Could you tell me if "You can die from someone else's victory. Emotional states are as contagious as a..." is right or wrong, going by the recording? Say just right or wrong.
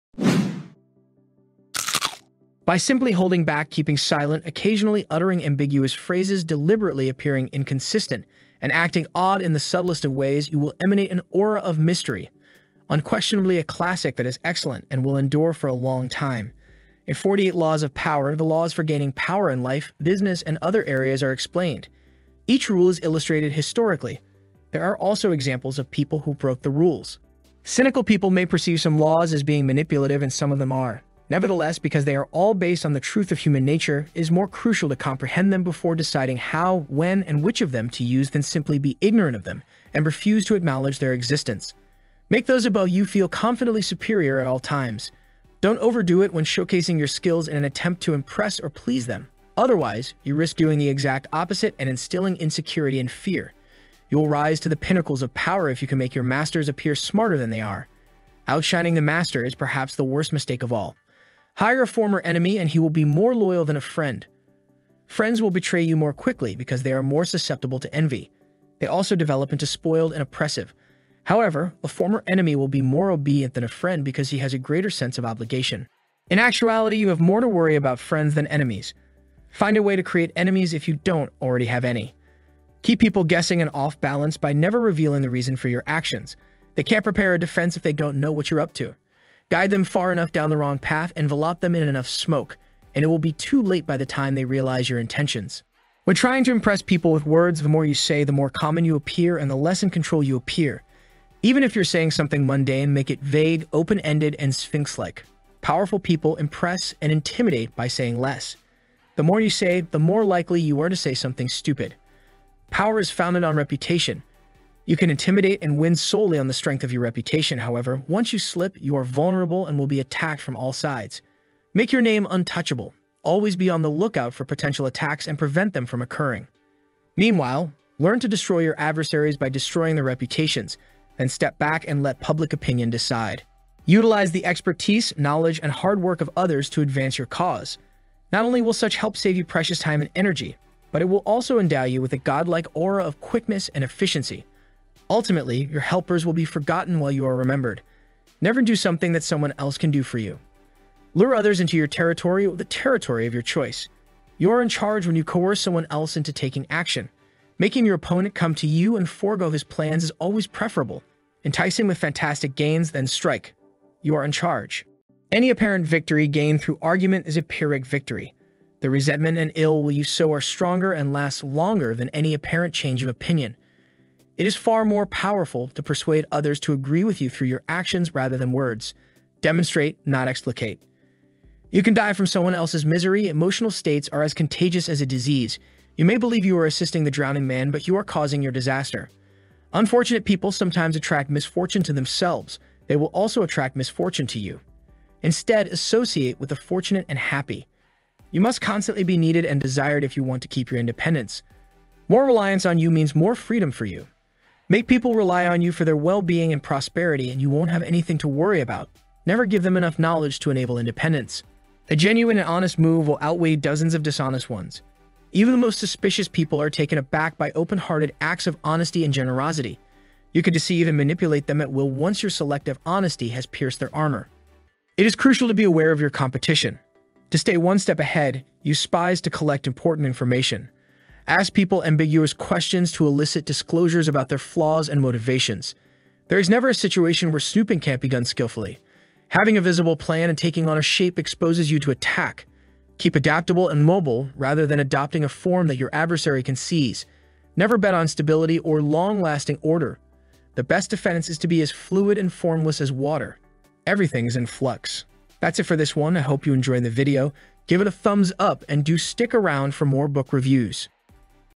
wrong.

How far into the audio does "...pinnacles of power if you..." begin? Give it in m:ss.
0:54.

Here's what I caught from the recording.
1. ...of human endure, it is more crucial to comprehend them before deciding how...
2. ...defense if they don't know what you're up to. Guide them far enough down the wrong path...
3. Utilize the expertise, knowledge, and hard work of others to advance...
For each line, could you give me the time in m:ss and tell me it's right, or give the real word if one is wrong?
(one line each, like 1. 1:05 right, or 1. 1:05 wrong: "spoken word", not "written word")
1. 0:33 wrong: "nature", not "endure"
2. 1:27 right
3. 2:13 right.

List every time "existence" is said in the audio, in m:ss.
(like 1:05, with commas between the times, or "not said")
0:41.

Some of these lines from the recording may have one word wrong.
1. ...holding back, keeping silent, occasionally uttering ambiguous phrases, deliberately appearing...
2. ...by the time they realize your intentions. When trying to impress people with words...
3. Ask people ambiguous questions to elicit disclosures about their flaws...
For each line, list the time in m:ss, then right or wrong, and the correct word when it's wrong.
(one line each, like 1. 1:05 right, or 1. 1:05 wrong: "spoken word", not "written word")
1. 0:03 right
2. 1:33 right
3. 3:51 right.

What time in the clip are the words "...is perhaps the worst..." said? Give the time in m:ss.
0:59.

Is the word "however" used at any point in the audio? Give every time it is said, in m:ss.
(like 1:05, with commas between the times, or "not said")
1:11, 1:57.